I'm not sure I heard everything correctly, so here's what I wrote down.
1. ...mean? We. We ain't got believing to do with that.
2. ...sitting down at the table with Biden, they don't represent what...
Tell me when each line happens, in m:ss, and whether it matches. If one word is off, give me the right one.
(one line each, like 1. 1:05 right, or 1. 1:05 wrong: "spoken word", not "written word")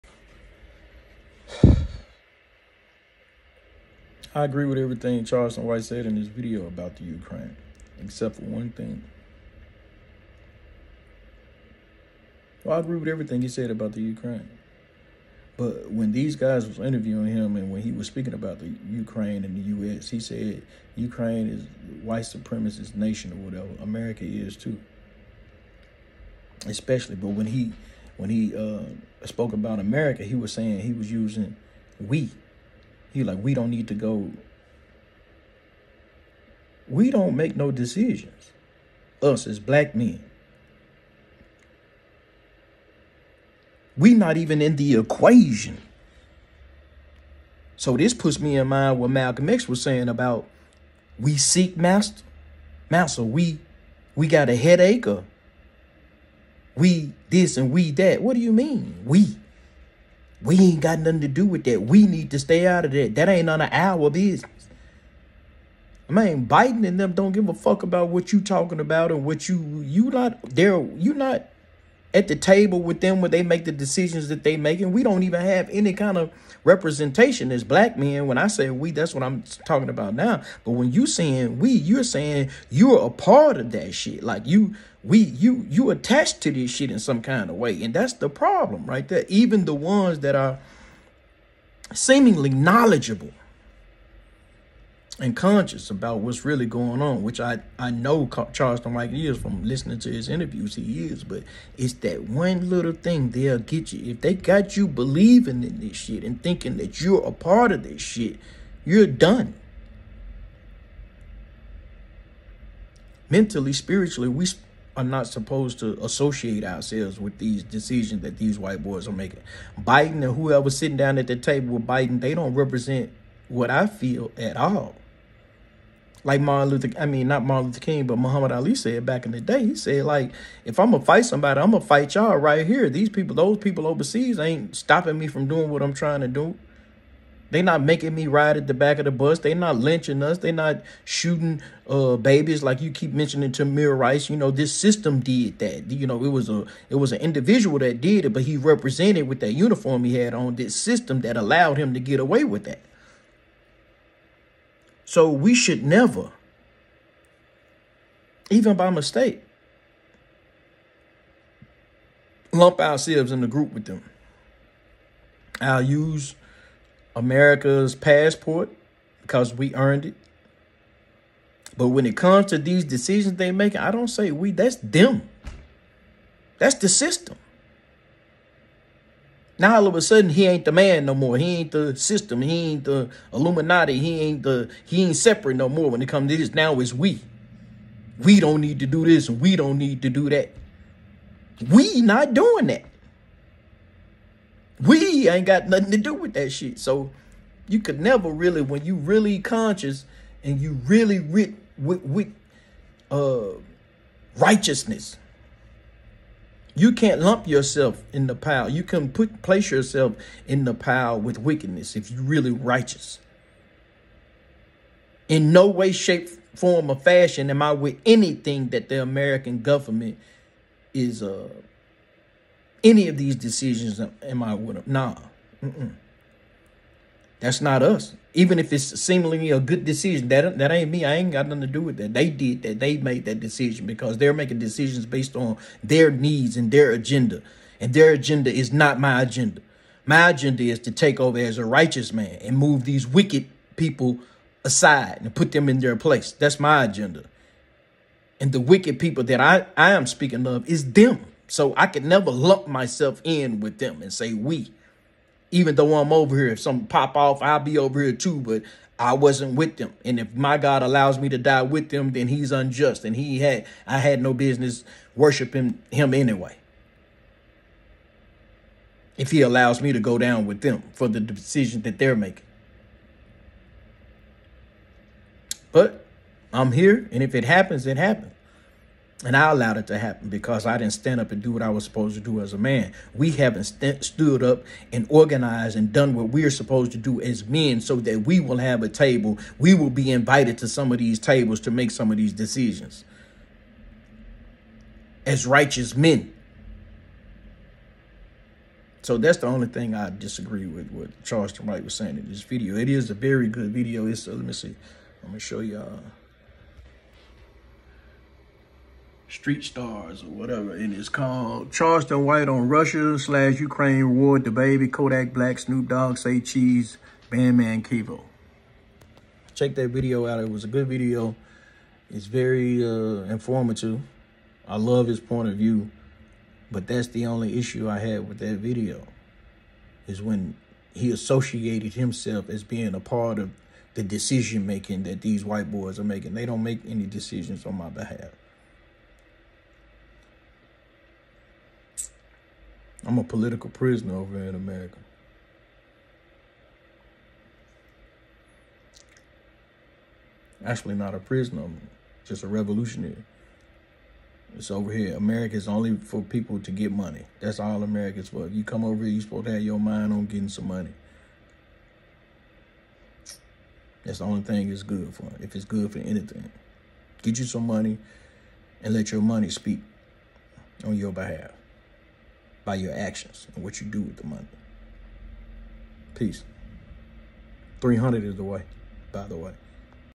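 1. 0:58 wrong: "nothing", not "believing"
2. 2:00 right.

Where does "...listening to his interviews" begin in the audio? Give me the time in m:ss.
1:39.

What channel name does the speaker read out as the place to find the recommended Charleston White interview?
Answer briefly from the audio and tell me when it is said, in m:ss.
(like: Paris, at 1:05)
Street Stars, at 5:09.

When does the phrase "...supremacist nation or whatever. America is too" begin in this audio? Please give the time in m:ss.
0:22.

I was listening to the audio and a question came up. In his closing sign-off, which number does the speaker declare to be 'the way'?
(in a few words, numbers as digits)
300.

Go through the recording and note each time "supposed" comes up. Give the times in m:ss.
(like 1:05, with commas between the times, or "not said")
1:55, 4:41, 4:46, 5:59.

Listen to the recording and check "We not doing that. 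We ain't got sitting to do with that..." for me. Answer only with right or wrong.
wrong.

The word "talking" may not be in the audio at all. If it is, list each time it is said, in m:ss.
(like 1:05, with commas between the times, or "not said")
1:08, 1:19.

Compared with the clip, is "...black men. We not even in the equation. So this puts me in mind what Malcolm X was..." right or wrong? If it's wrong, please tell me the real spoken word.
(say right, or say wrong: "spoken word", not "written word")
right.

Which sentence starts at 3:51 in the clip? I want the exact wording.
I ain't got nothing to do with that.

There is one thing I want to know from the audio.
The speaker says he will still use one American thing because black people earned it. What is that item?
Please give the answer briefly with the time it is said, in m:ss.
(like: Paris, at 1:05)
Passport, at 2:47.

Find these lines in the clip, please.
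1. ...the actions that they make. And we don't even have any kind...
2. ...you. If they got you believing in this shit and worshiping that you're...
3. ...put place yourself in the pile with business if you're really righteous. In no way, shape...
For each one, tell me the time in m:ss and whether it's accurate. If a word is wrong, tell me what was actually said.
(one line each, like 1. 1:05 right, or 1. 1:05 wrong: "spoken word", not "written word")
1. 1:13 wrong: "decisions", not "actions"
2. 1:43 wrong: "thinking", not "worshiping"
3. 3:29 wrong: "wickedness", not "business".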